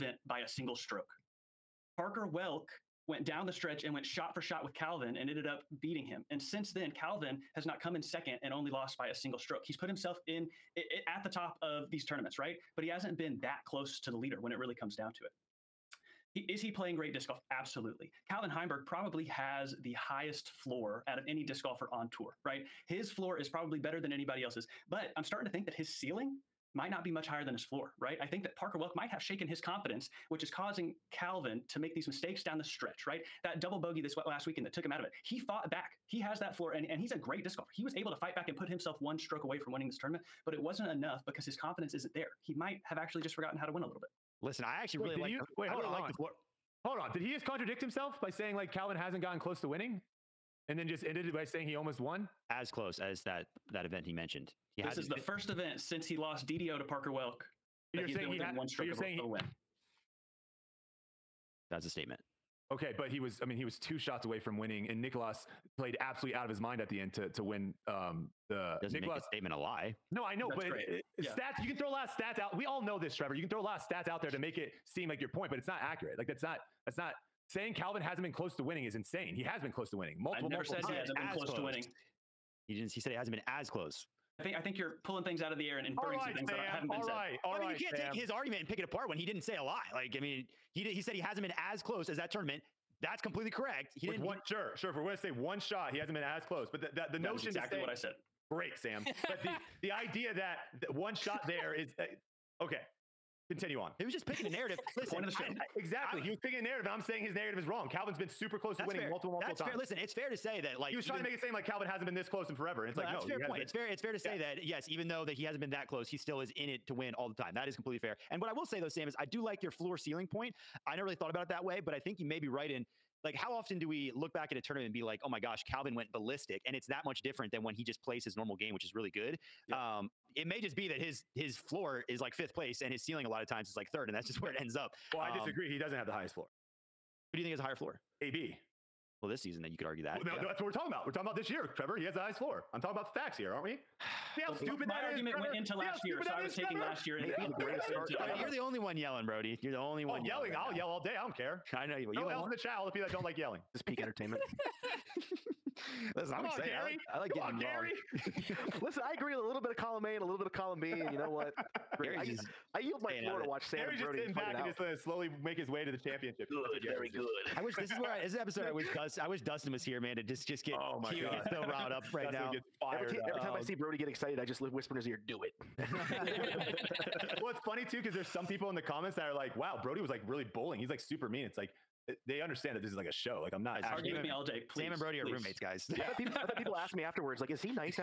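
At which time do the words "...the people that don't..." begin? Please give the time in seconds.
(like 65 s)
152 s.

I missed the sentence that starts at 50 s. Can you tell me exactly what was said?
And then just ended it by saying he almost won?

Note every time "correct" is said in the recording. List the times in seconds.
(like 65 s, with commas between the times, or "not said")
93 s.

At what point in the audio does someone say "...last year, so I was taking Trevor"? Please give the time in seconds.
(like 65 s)
145 s.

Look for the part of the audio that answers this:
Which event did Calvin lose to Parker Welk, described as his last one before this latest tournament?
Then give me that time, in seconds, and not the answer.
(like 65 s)
56 s.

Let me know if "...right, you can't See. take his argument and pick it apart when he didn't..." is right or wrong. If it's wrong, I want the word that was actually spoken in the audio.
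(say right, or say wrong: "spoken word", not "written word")
wrong: "Sam", not "See".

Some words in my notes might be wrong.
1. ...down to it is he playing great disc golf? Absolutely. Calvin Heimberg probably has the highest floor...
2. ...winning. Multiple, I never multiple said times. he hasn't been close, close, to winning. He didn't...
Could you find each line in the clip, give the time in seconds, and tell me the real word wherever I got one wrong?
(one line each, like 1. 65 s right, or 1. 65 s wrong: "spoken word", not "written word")
1. 14 s right
2. 79 s right.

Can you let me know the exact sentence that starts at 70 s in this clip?
No, I know, That's but it, it, yeah.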